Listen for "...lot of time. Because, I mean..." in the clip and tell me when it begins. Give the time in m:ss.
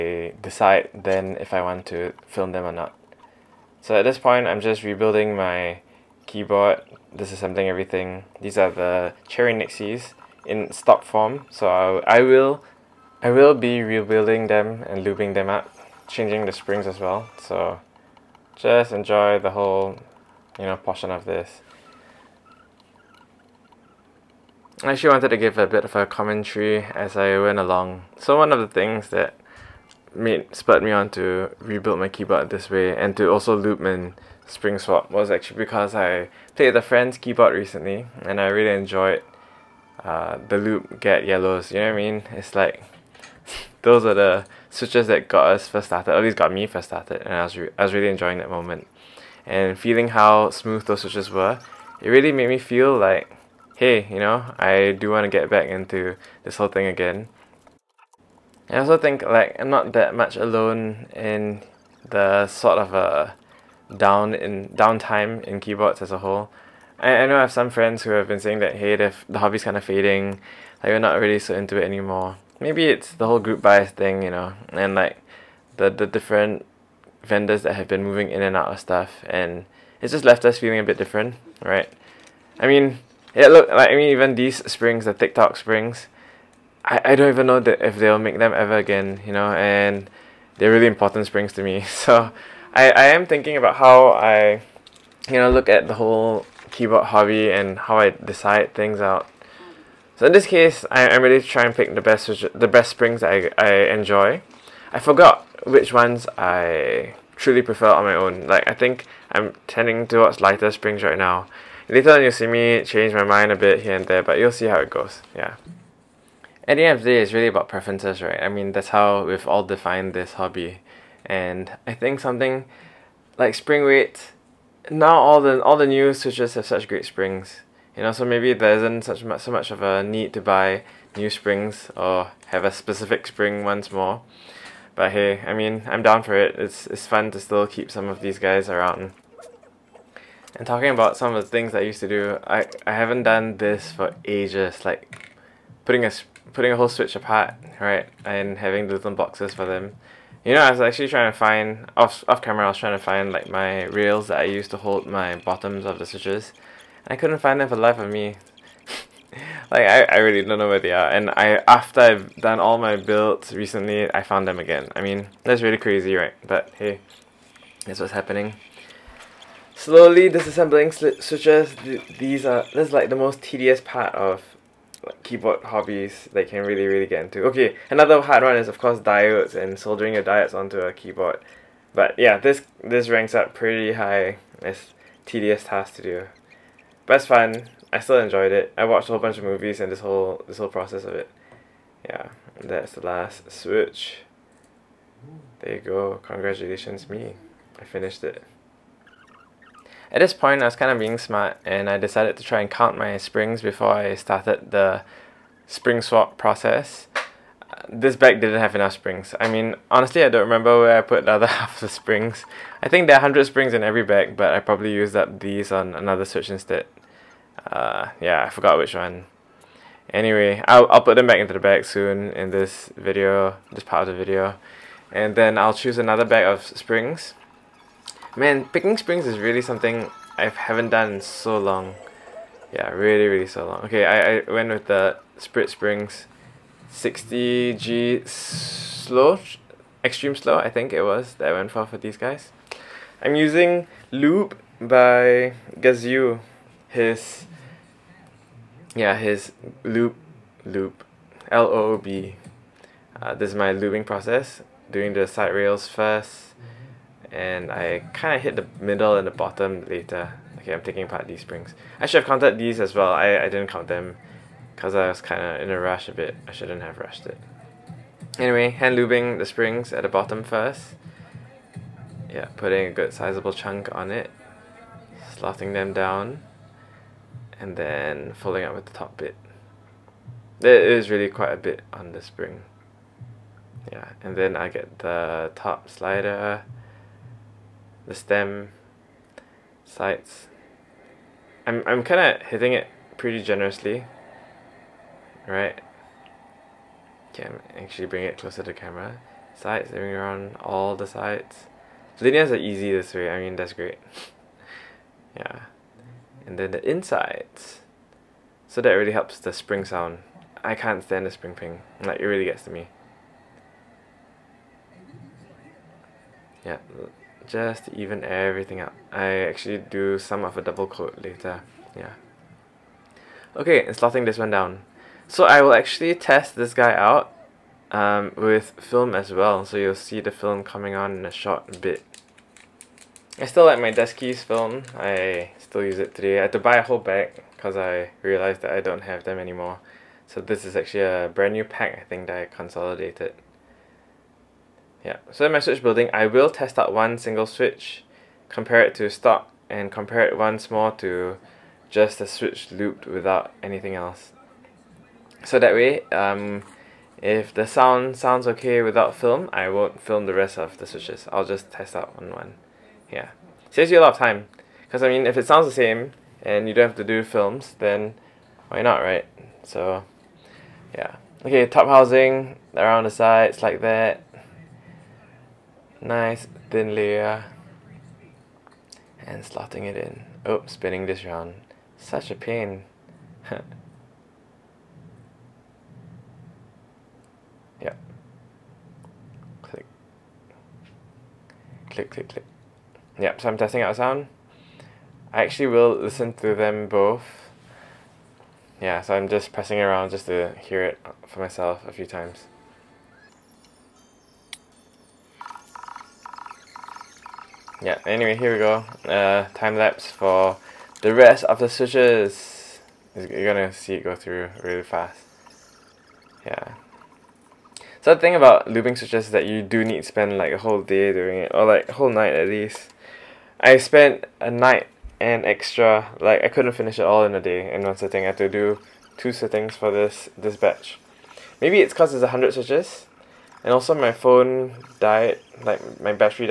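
6:04.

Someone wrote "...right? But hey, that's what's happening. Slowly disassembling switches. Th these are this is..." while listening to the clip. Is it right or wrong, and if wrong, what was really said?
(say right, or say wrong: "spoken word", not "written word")
right.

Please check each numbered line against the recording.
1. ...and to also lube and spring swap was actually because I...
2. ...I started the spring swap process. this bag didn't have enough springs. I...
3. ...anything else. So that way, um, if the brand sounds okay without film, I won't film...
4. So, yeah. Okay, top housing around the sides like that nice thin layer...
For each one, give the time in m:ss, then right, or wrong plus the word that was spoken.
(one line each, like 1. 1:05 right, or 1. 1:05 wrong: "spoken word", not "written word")
1. 0:32 right
2. 3:23 right
3. 5:53 wrong: "sound", not "brand"
4. 6:09 right.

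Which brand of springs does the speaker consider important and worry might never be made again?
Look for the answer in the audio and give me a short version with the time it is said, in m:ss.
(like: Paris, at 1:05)
TikTok springs, at 1:25.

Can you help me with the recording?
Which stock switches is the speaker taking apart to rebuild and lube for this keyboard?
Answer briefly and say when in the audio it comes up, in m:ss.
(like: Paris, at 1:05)
Cherry Nixies, at 0:09.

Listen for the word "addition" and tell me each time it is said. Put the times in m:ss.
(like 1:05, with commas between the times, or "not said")
not said.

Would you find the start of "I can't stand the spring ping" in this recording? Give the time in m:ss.
5:10.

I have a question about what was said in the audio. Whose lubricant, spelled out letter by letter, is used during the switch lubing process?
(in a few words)
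Gazzew.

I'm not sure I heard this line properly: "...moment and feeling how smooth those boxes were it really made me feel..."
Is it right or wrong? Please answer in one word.
wrong.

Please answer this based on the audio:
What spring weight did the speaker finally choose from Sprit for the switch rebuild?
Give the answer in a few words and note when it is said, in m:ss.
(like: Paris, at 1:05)
60g, at 3:56.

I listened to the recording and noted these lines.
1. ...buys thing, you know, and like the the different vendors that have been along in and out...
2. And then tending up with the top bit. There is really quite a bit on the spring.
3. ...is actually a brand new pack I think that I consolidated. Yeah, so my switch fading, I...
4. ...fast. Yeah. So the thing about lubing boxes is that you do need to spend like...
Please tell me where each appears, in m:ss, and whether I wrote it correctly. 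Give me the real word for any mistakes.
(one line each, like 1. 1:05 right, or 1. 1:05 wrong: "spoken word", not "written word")
1. 1:13 wrong: "moving", not "along"
2. 4:37 wrong: "folding", not "tending"
3. 5:40 wrong: "building", not "fading"
4. 6:54 wrong: "switches", not "boxes".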